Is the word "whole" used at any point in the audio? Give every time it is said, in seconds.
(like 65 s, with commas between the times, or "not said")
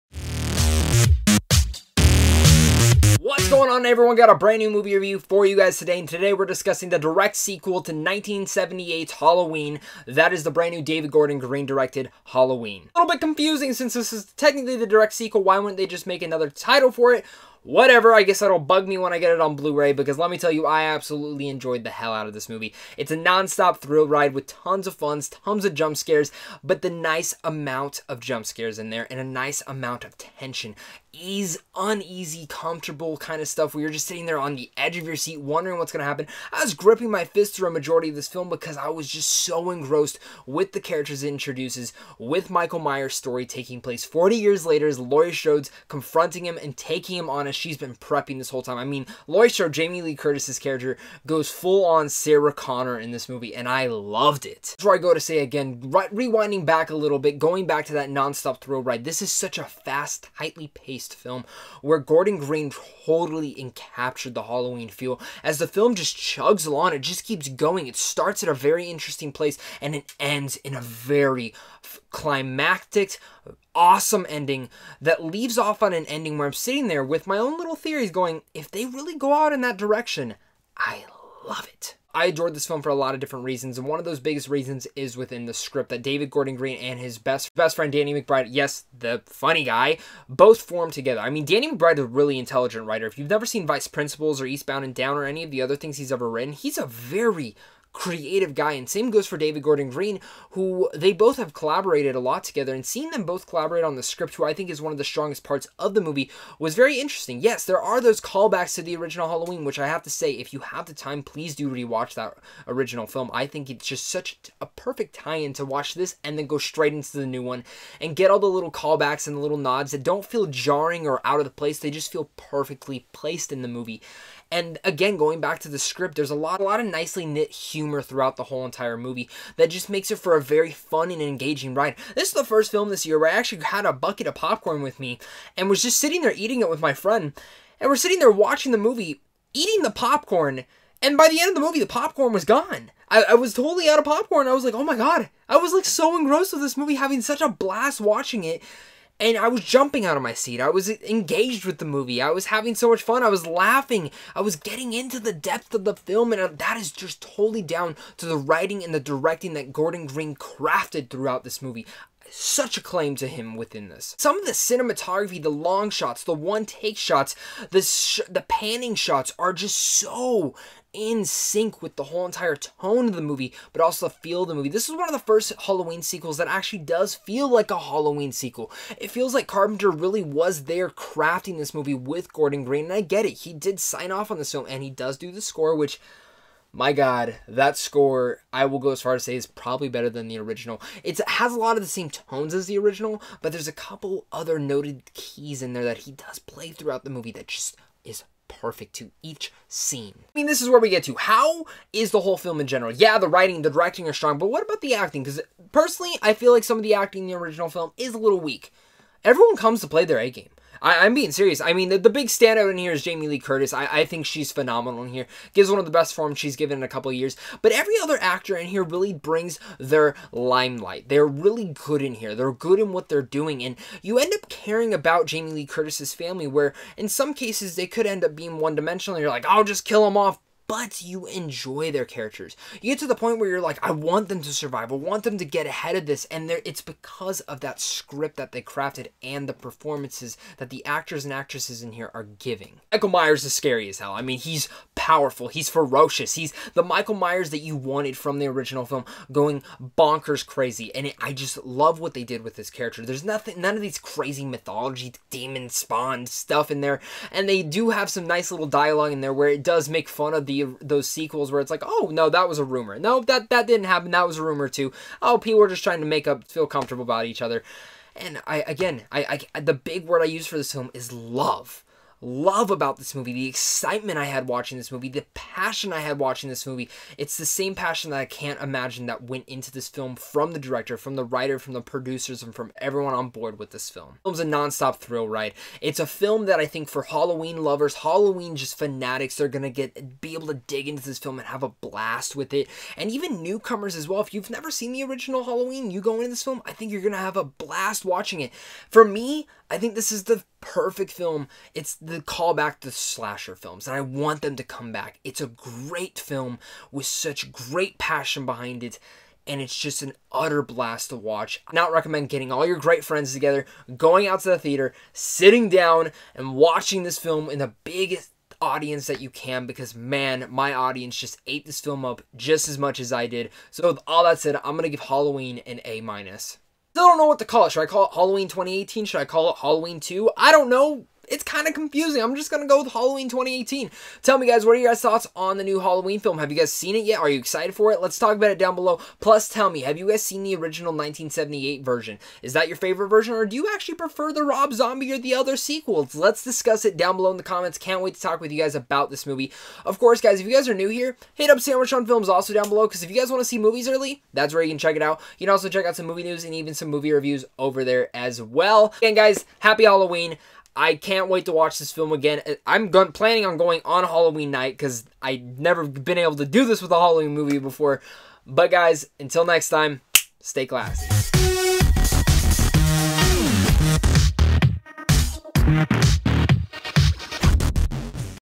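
48 s, 128 s, 172 s, 202 s.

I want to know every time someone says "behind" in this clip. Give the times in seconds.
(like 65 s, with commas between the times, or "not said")
308 s.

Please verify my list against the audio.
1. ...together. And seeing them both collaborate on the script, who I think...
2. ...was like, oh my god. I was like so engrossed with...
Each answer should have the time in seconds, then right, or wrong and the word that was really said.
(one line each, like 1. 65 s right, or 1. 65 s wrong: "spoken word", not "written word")
1. 102 s right
2. 144 s right.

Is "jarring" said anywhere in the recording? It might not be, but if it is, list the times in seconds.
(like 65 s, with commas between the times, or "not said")
120 s.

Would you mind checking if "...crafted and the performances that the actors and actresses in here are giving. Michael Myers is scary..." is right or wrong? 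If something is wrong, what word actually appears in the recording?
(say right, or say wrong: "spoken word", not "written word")
right.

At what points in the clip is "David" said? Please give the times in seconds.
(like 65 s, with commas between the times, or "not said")
10 s, 86 s, 99 s.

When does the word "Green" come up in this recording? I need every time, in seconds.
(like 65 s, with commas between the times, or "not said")
11 s, 62 s, 86 s, 99 s, 160 s, 182 s.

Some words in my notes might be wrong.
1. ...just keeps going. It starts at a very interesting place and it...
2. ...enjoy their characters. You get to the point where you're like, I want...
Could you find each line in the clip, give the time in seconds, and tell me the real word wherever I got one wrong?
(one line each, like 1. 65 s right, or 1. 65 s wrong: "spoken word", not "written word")
1. 67 s right
2. 231 s right.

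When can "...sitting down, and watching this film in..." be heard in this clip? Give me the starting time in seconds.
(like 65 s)
315 s.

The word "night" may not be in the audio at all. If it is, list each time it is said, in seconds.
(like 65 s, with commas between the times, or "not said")
364 s.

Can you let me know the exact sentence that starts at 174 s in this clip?
This is one of the first Halloween sequels that actually does feel like a Halloween sequel.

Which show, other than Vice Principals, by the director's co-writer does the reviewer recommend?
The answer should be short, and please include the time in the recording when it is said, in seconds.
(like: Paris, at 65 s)
Eastbound and Down, at 94 s.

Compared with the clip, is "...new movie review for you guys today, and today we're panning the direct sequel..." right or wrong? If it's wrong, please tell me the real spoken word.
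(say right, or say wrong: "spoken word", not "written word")
wrong: "discussing", not "panning".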